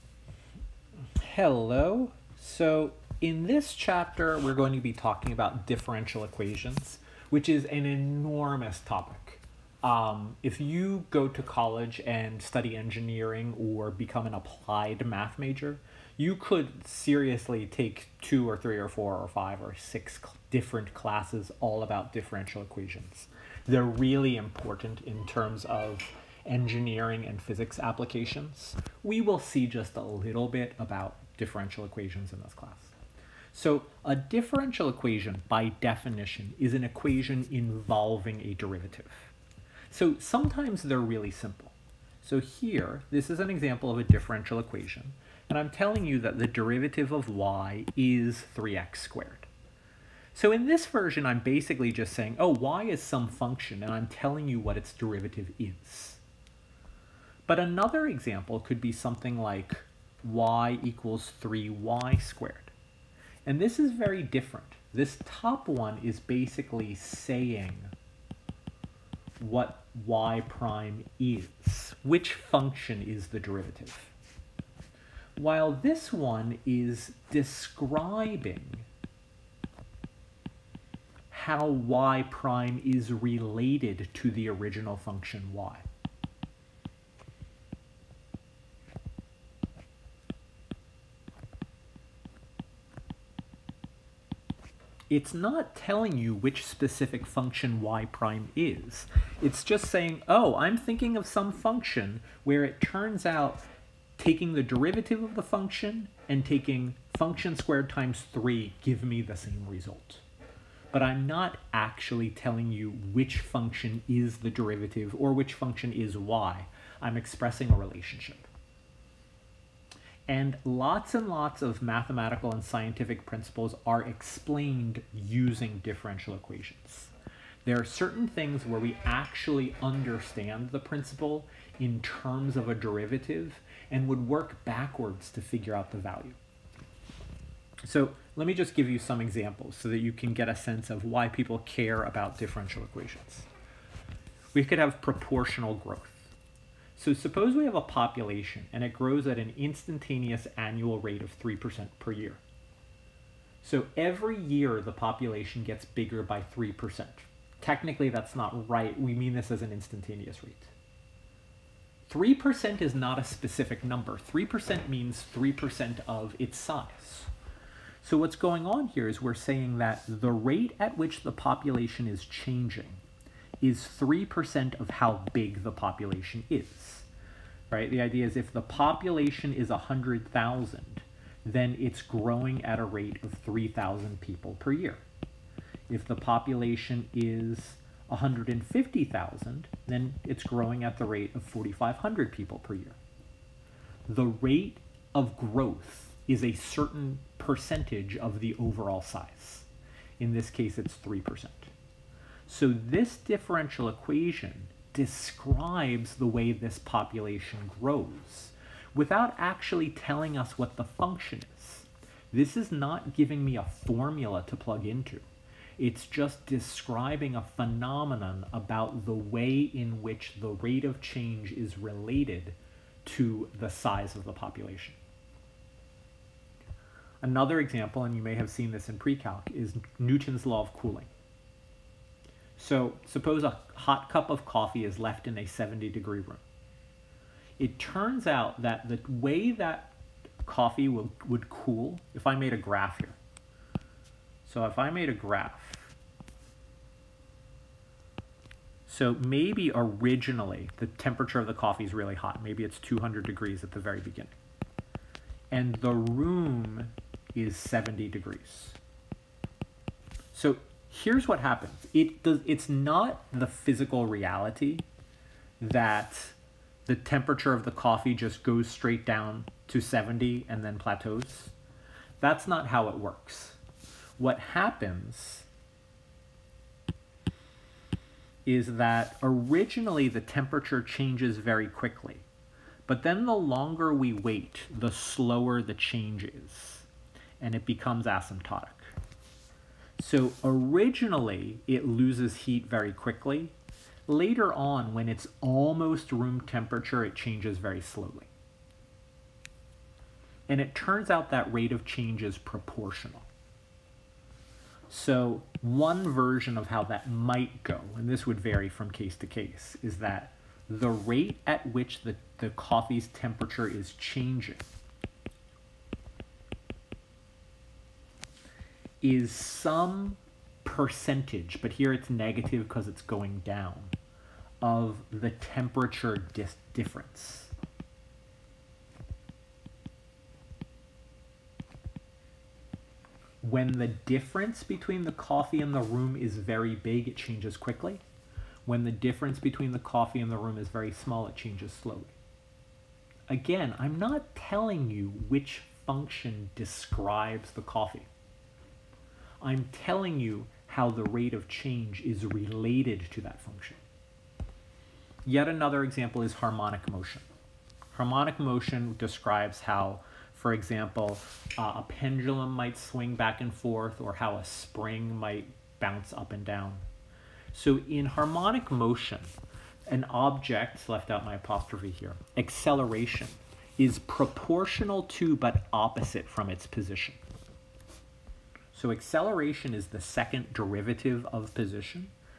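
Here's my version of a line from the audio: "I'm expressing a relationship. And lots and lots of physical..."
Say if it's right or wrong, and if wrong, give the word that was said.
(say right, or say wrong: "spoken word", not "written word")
wrong: "mathematical", not "physical".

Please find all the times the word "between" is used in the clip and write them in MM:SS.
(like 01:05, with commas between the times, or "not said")
05:34, 05:39.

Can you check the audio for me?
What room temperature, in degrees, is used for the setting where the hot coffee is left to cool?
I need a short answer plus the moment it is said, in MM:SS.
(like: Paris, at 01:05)
70, at 03:55.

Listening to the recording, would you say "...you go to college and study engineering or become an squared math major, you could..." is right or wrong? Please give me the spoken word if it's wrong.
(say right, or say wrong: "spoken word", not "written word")
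wrong: "applied", not "squared".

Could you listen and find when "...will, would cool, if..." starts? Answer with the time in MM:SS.
04:00.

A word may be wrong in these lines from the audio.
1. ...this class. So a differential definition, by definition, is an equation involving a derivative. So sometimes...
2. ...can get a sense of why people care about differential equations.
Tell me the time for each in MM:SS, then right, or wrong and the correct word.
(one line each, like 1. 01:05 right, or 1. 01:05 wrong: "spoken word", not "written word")
1. 00:32 wrong: "equation", not "definition"
2. 02:20 right.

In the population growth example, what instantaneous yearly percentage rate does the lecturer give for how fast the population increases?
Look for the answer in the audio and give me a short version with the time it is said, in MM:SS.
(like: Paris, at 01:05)
3%, at 02:31.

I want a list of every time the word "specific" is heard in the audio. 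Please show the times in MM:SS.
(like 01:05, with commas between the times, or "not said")
01:36, 02:43.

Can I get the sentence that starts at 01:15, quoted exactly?
While this one is describing how y prime is related to the original function y.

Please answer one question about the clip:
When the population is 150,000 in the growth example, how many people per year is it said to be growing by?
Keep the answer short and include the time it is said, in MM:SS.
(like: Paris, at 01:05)
4,500, at 03:11.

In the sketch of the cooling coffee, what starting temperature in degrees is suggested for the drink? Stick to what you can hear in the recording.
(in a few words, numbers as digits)
200.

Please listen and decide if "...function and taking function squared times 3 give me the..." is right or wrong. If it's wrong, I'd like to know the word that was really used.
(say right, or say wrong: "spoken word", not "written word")
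right.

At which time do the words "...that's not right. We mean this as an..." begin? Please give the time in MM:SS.
02:38.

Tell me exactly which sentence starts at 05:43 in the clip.
Again, I'm not telling you which function describes the coffee.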